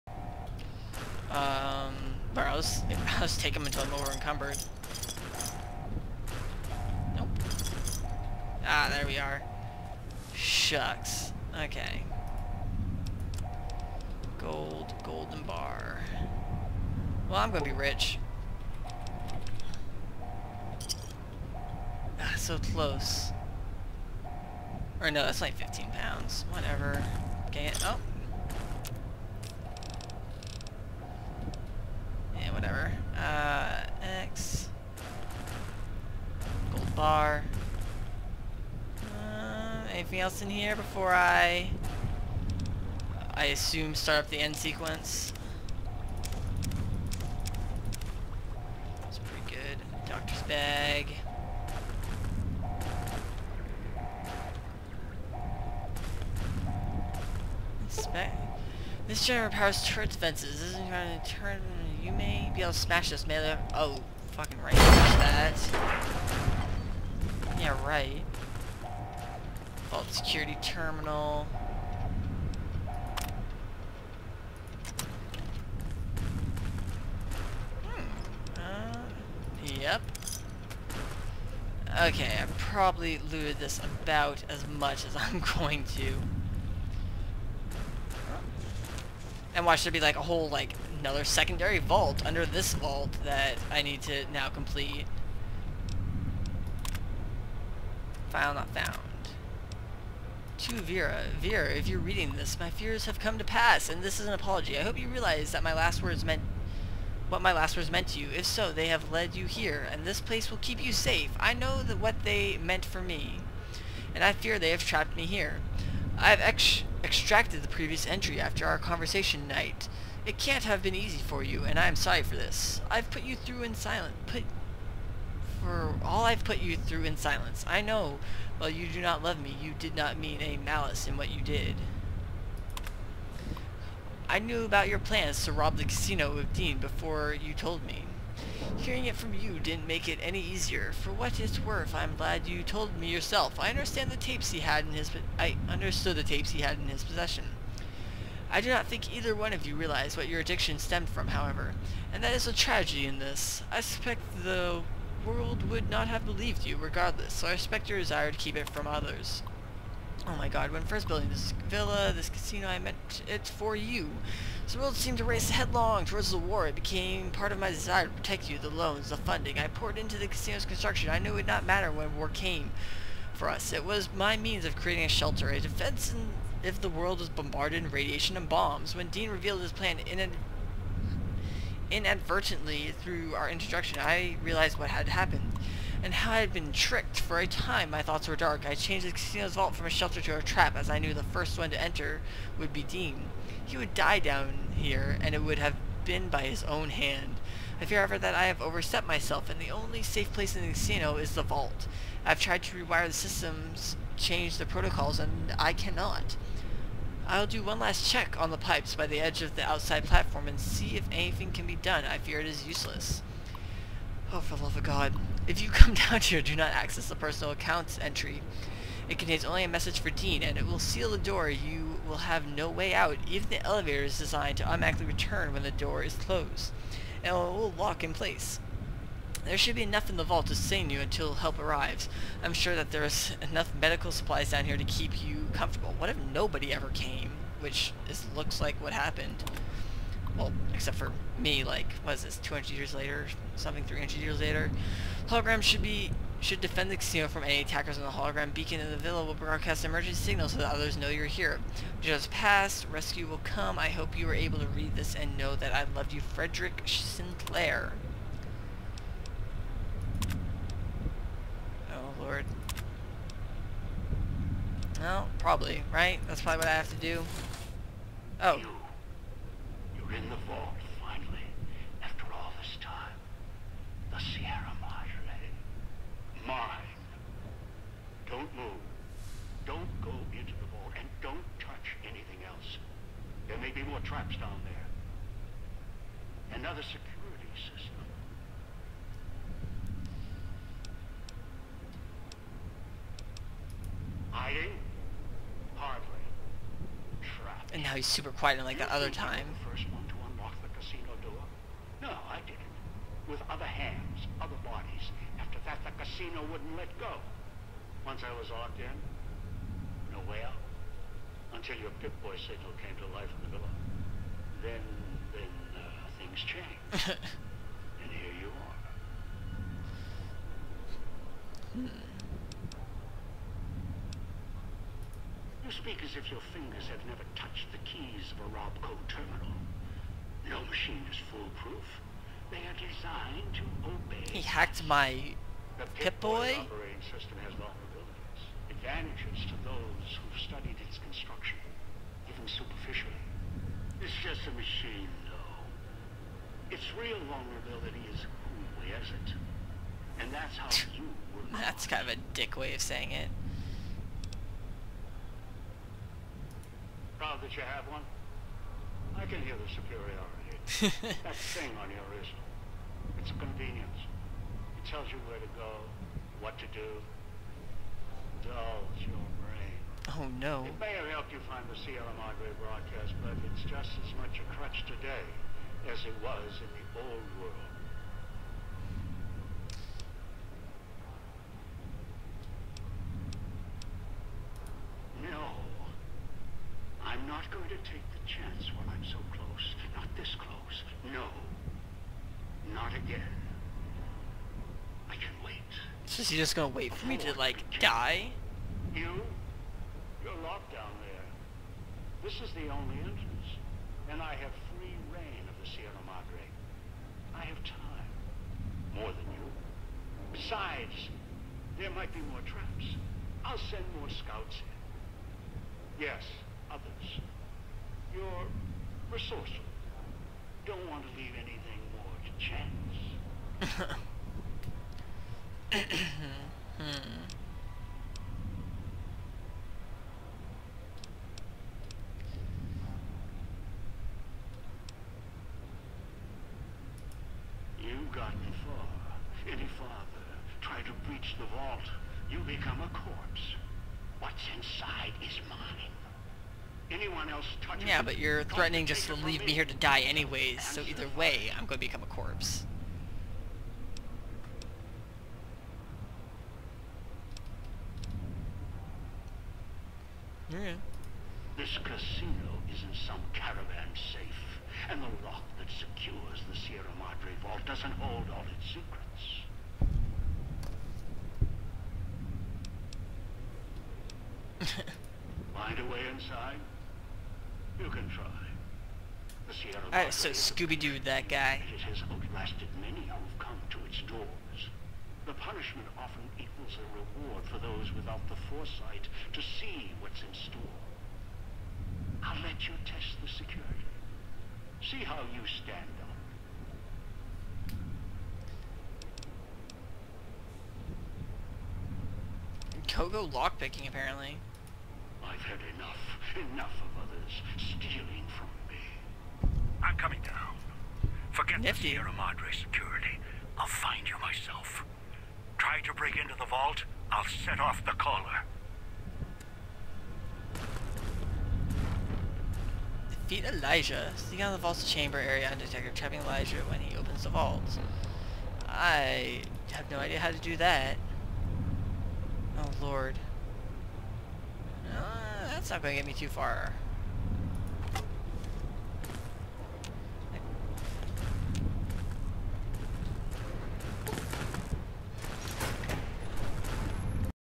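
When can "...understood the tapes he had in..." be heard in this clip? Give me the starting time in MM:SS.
02:25.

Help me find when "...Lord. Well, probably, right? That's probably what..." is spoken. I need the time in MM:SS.
04:22.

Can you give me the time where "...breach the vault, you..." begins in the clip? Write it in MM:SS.
07:21.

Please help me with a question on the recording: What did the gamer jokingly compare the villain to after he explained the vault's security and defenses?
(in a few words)
Scooby-Doo.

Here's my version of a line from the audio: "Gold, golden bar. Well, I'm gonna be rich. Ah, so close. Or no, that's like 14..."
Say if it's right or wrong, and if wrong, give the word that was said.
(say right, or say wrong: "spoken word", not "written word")
wrong: "15", not "14".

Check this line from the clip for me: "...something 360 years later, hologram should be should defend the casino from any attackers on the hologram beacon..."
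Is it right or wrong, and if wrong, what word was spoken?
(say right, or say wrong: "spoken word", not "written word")
wrong: "300", not "360".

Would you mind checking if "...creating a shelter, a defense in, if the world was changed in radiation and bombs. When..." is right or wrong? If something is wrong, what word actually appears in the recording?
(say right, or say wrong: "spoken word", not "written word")
wrong: "bombarded", not "changed".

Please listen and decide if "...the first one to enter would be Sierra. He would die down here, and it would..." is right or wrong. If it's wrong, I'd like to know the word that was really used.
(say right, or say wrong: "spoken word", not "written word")
wrong: "Dean", not "Sierra".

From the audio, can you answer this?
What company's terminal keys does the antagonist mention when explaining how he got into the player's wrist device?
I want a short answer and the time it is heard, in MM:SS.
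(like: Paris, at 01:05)
Robco, at 05:28.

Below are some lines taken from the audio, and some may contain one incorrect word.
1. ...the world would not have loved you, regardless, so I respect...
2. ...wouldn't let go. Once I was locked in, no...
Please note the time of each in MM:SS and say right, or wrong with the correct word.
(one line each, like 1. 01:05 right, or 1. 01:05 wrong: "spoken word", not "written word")
1. 02:34 wrong: "believed", not "loved"
2. 05:06 right.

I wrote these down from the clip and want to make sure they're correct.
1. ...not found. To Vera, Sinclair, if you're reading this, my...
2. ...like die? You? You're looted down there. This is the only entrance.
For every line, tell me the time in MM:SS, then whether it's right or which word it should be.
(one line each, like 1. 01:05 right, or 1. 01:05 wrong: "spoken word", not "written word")
1. 01:38 wrong: "Vera", not "Sinclair"
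2. 06:37 wrong: "locked", not "looted".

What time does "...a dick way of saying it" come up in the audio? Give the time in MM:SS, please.
05:52.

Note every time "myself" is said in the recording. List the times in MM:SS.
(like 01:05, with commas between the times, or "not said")
03:19, 08:34.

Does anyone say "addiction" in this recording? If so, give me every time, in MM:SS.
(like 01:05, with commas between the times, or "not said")
02:30.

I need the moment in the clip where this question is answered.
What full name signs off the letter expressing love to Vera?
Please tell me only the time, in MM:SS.
04:16.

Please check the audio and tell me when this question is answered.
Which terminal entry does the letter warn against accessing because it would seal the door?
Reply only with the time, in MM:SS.
03:37.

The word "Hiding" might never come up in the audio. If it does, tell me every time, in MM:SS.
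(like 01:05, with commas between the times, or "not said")
04:54.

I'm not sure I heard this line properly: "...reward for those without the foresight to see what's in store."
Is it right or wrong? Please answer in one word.
right.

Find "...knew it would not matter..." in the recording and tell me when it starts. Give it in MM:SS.
02:51.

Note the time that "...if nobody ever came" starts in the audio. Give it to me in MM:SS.
03:56.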